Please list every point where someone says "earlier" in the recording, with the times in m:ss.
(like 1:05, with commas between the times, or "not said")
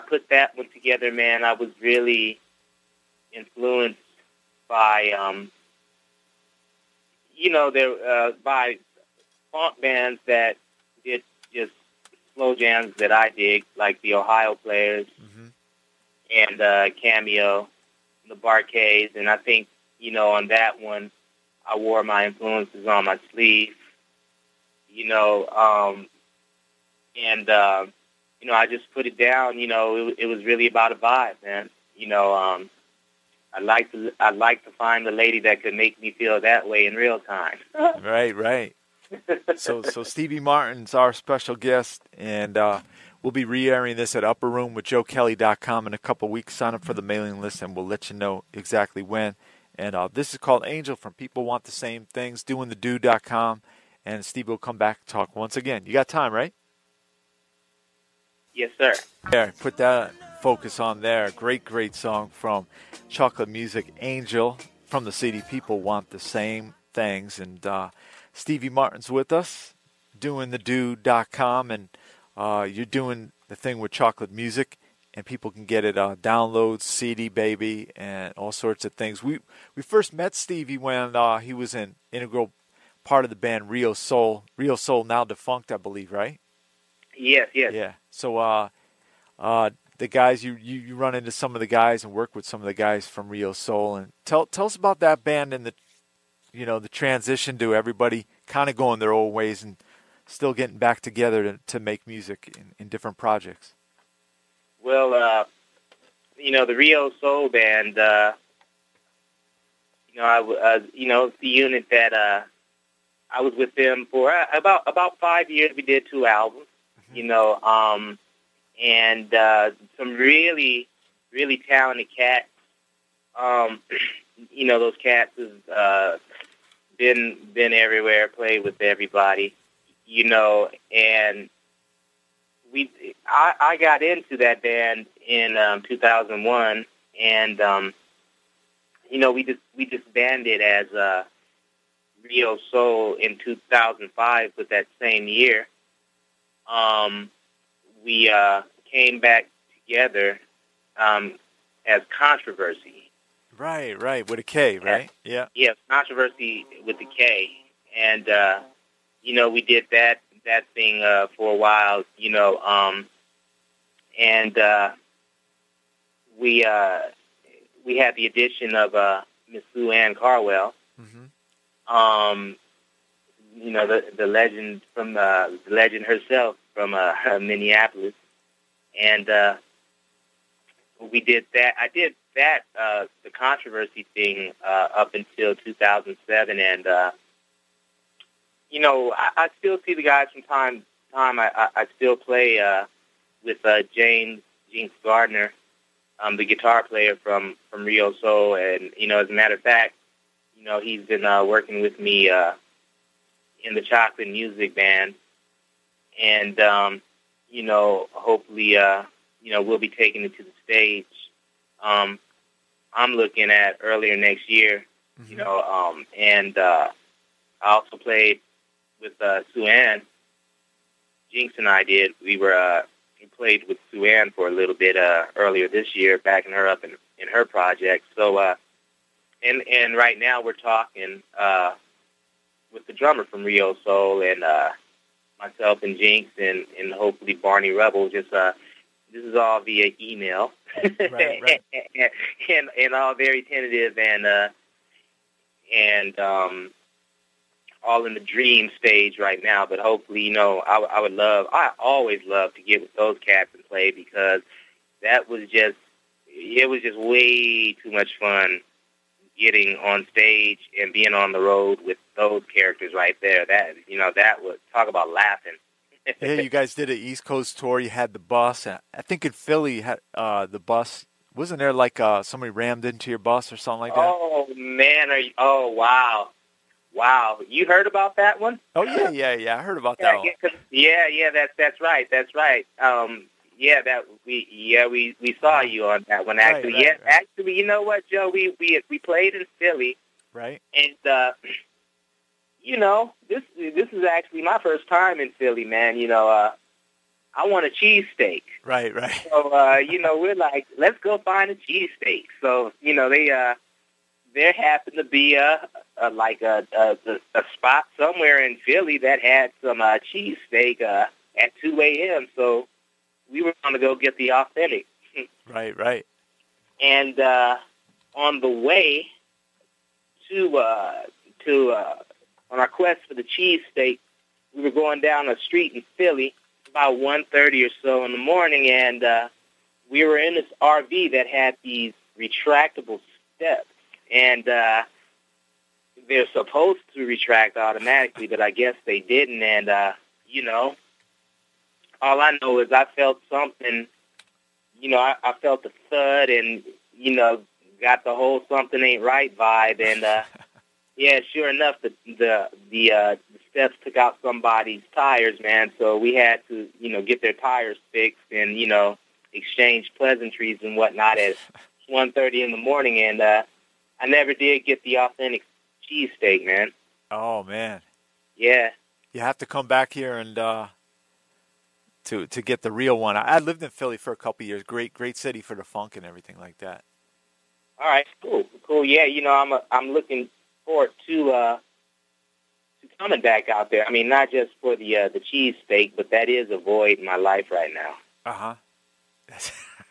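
3:33, 3:45.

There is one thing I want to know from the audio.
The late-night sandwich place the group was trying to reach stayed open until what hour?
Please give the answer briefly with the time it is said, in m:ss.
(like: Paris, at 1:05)
2 a.m., at 5:11.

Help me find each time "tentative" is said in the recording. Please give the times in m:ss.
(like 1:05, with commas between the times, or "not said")
4:03.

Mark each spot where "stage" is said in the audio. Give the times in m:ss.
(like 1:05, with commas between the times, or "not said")
3:30, 4:08, 4:20.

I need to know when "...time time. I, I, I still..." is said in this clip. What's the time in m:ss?
3:10.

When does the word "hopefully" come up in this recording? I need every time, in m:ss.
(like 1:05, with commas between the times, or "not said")
3:28, 3:56, 4:09.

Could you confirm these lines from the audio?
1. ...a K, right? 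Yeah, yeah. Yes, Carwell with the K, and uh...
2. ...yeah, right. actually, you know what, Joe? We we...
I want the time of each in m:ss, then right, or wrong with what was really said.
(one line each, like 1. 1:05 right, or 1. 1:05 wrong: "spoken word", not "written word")
1. 2:34 wrong: "Kontroversy", not "Carwell"
2. 4:46 right.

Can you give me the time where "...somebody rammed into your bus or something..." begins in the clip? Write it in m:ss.
4:32.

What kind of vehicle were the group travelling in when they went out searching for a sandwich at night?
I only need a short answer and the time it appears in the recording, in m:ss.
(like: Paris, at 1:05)
RV, at 5:30.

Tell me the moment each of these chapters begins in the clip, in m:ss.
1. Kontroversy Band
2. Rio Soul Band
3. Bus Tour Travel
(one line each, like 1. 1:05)
1. 2:45
2. 1:30
3. 4:45.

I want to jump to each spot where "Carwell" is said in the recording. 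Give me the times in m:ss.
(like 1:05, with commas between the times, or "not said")
2:50.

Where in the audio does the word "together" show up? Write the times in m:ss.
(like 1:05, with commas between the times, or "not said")
0:00, 1:41, 2:29.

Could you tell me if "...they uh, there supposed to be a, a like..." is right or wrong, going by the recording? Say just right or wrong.
wrong.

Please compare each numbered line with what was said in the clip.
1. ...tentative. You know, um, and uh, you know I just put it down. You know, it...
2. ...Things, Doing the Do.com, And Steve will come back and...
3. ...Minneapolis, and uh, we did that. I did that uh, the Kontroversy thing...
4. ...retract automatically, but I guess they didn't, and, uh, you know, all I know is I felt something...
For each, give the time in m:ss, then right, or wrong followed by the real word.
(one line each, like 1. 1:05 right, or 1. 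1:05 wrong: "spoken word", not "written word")
1. 0:23 wrong: "sleeve", not "tentative"
2. 0:52 right
3. 2:57 right
4. 5:37 right.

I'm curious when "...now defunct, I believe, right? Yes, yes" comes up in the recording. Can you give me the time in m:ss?
1:25.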